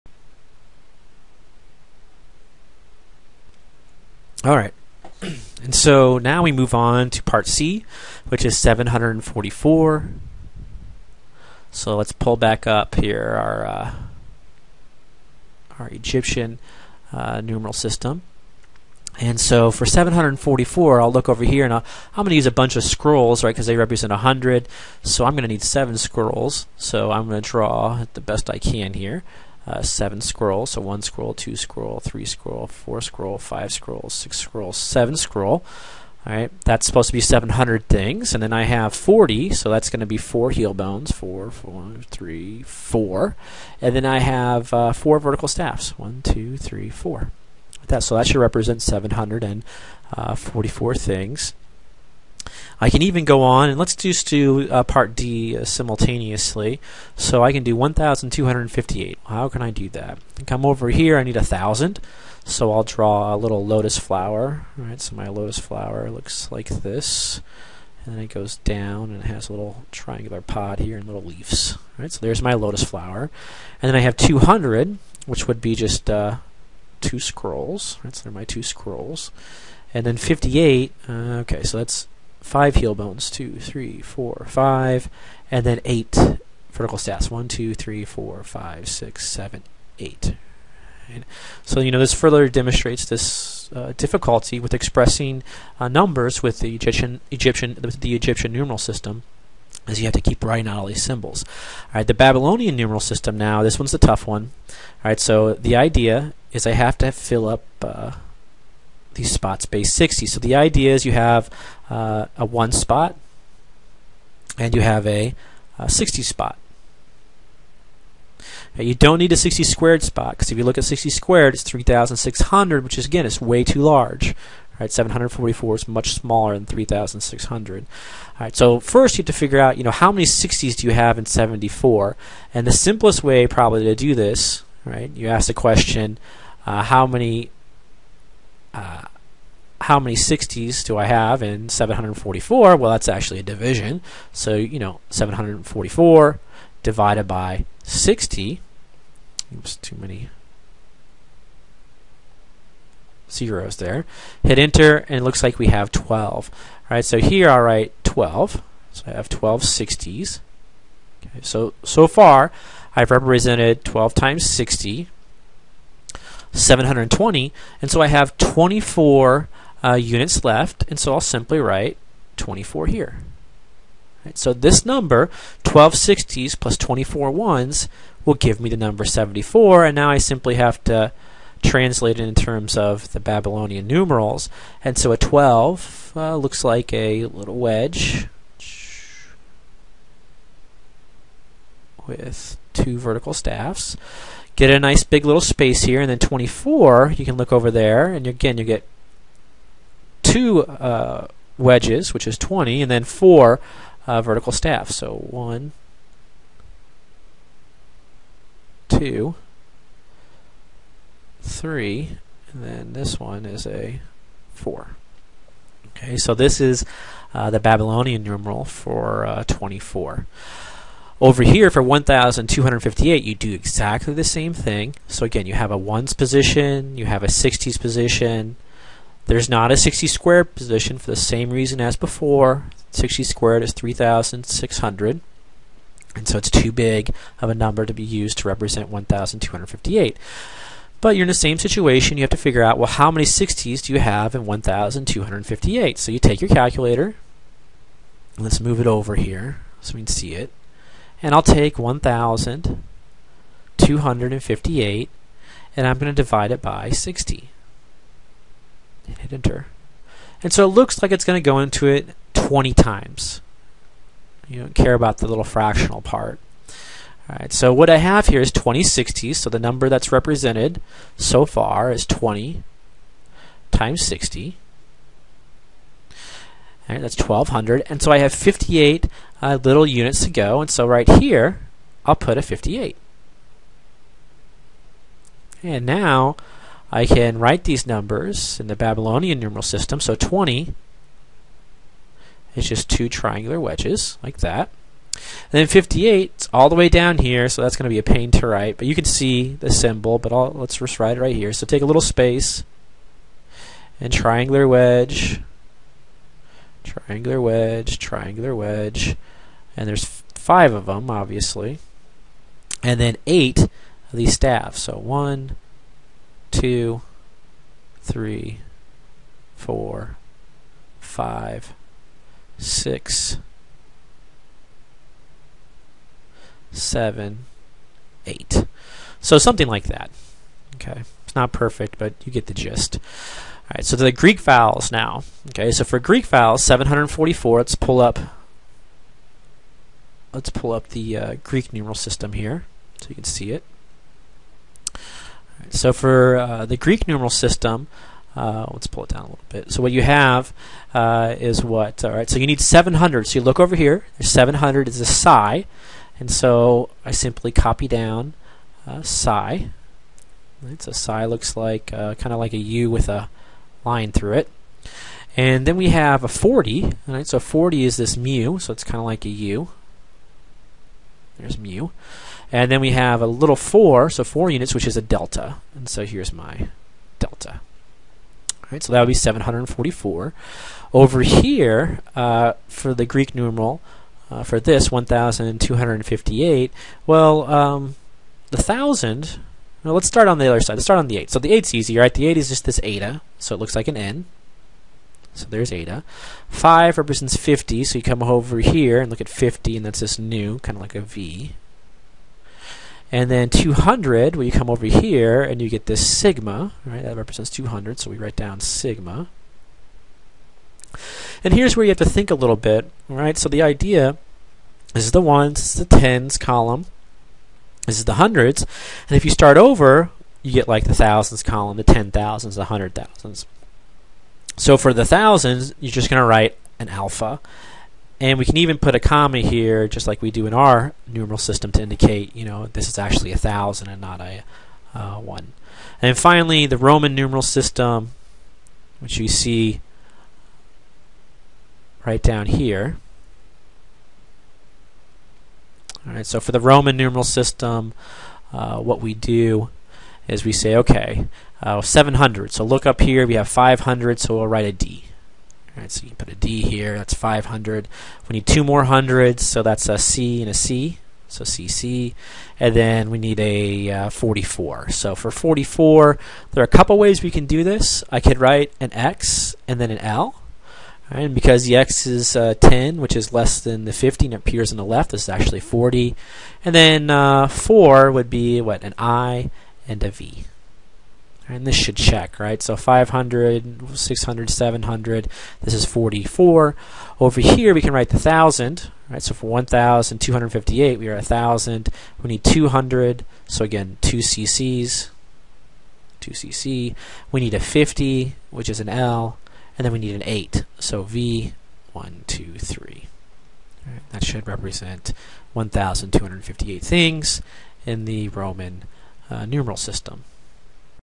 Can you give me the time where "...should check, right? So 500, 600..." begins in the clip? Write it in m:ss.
8:01.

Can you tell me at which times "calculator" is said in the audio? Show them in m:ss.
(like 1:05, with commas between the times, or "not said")
4:06.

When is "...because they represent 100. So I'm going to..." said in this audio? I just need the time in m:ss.
0:23.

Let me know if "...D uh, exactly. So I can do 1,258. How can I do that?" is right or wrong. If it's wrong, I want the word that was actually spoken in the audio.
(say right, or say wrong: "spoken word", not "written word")
wrong: "simultaneously", not "exactly".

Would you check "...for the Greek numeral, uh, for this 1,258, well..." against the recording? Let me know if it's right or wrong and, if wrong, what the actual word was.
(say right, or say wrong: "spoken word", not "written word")
right.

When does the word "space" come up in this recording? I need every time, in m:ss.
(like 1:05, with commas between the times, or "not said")
1:49, 3:15, 5:02.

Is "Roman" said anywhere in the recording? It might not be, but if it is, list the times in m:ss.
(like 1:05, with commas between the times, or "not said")
7:16, 7:26, 8:28.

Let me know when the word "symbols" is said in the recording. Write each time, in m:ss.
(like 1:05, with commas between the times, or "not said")
1:41, 4:59.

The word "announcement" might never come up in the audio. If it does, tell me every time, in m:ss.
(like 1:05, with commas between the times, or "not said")
not said.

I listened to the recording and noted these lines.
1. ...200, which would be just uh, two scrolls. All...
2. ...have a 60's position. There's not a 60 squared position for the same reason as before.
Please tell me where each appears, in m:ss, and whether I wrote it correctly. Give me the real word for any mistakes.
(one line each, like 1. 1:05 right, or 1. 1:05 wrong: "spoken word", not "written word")
1. 1:14 right
2. 3:47 right.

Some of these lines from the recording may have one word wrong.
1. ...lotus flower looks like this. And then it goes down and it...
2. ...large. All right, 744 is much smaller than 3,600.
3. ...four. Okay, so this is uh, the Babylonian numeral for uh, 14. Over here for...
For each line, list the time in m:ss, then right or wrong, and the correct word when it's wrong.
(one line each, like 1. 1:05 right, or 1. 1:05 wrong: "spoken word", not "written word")
1. 1:05 right
2. 2:03 right
3. 3:34 wrong: "24", not "14".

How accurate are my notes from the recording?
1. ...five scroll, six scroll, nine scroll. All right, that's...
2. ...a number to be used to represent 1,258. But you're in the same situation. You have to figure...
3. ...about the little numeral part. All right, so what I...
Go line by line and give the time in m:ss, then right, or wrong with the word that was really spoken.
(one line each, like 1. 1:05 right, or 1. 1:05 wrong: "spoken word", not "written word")
1. 0:33 wrong: "seven", not "nine"
2. 3:57 right
3. 4:24 wrong: "fractional", not "numeral".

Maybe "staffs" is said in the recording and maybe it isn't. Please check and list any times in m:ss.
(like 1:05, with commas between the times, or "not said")
0:45, 1:26, 3:13, 3:24, 5:14.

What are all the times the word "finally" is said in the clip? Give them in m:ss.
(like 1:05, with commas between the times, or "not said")
7:16.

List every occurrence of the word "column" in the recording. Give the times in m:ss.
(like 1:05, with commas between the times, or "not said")
6:56, 7:01.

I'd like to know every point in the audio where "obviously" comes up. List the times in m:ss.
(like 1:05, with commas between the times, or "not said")
5:11.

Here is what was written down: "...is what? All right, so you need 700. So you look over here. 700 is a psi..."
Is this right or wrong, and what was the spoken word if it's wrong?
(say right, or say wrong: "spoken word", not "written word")
right.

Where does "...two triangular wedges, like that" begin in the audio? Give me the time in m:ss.
4:52.